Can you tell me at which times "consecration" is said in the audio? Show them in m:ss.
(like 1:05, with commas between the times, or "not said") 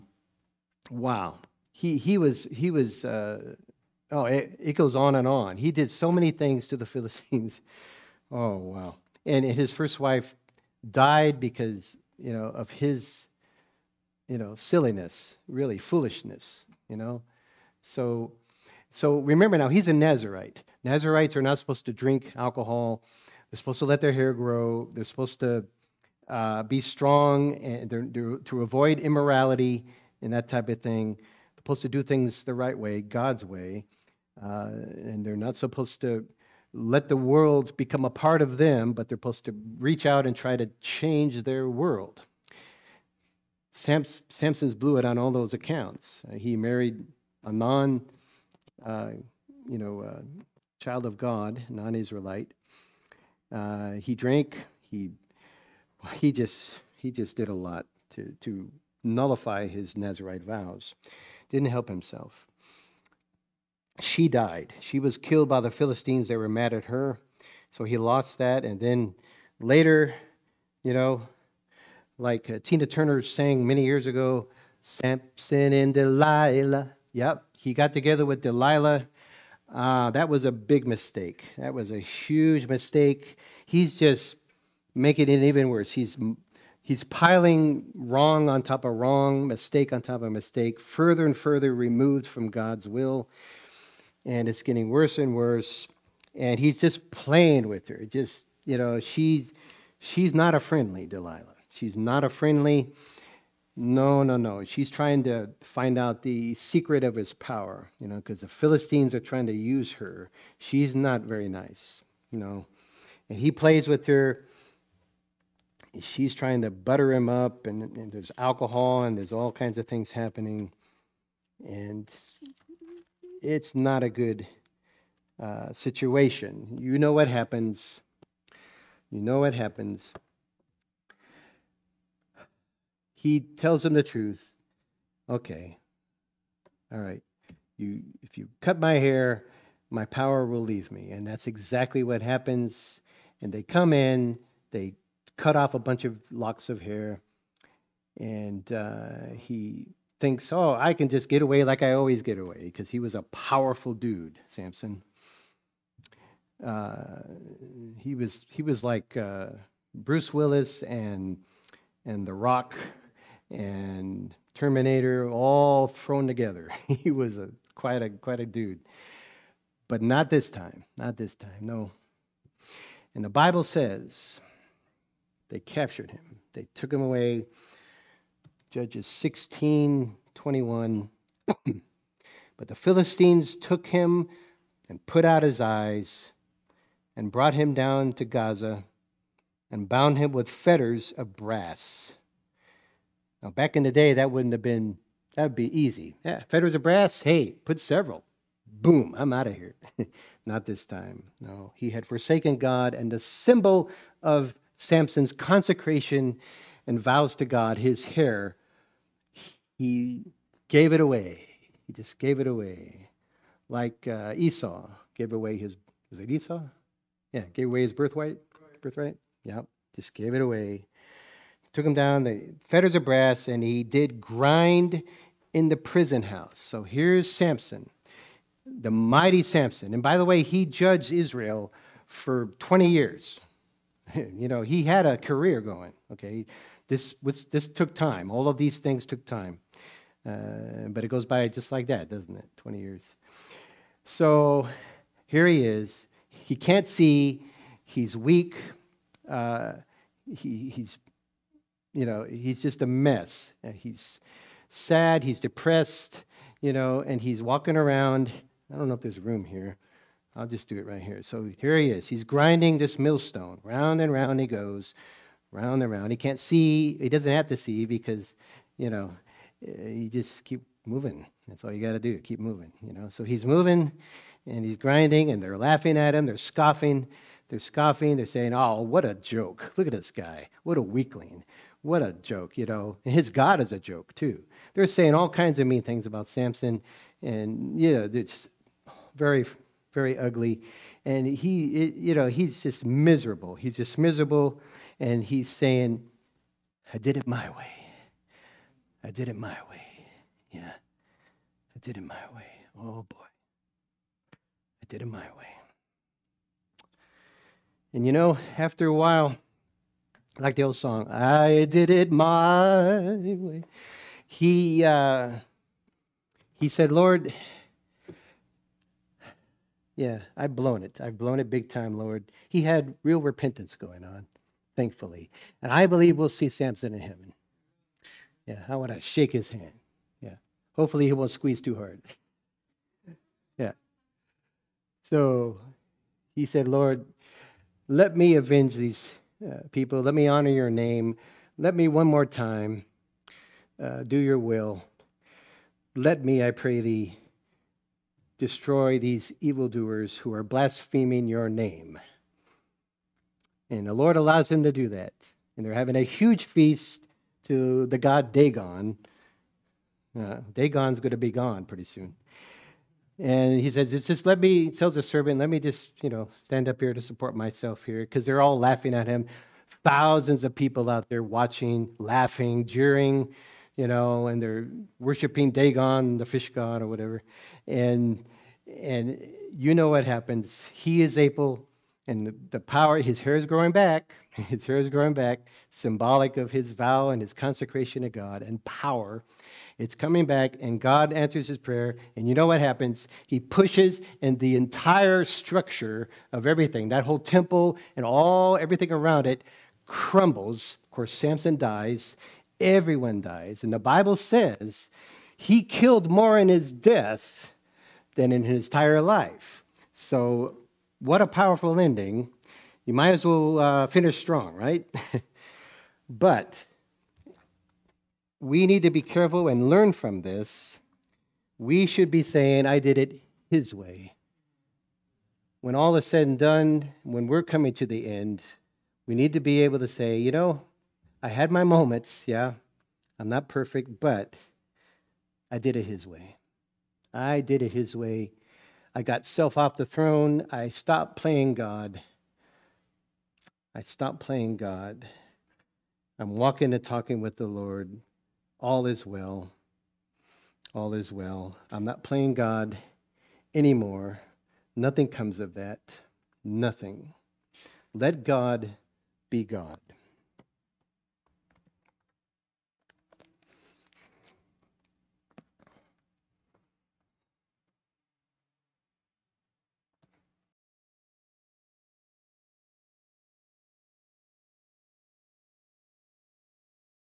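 3:25, 6:27.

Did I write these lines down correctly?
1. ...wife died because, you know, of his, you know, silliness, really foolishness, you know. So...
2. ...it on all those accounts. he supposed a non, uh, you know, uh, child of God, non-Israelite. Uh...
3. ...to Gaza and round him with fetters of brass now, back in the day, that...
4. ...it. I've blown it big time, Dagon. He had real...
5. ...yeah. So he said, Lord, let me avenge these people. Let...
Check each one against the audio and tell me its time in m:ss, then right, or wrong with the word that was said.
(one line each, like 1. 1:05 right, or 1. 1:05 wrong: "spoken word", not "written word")
1. 0:09 right
2. 0:44 wrong: "married", not "supposed"
3. 3:08 wrong: "bound", not "round"
4. 5:20 wrong: "Lord", not "Dagon"
5. 5:33 right.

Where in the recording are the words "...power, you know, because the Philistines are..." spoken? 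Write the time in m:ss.
1:47.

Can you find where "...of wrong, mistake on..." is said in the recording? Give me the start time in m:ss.
1:28.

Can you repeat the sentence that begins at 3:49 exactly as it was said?
And by the way, he judged Israel for 20 years.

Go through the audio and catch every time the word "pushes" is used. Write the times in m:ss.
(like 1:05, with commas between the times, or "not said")
6:33.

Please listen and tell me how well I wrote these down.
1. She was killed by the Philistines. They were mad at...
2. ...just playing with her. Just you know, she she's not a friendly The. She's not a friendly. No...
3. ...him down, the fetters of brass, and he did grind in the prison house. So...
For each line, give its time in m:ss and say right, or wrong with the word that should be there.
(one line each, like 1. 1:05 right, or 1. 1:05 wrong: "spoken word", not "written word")
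1. 1:04 right
2. 1:36 wrong: "Delilah", not "The"
3. 3:41 right.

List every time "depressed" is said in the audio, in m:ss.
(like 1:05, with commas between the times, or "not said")
4:15.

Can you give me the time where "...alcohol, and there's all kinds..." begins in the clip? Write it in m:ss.
1:58.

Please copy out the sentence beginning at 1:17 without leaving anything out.
Yep, he got together with Delilah.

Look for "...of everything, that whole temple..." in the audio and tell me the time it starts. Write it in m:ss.
6:36.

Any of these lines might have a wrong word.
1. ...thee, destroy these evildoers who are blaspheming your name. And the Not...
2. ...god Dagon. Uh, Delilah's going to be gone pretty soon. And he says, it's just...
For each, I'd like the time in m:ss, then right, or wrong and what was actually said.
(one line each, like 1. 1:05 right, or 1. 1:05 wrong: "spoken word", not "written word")
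1. 5:46 wrong: "Lord", not "Not"
2. 5:57 wrong: "Dagon", not "Delilah".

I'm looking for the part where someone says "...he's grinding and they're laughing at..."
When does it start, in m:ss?
4:34.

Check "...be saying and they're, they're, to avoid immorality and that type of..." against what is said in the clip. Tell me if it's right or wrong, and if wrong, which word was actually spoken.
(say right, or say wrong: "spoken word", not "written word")
wrong: "strong", not "saying".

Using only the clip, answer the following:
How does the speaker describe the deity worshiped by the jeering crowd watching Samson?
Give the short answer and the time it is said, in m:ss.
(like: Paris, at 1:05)
the fish god, at 6:16.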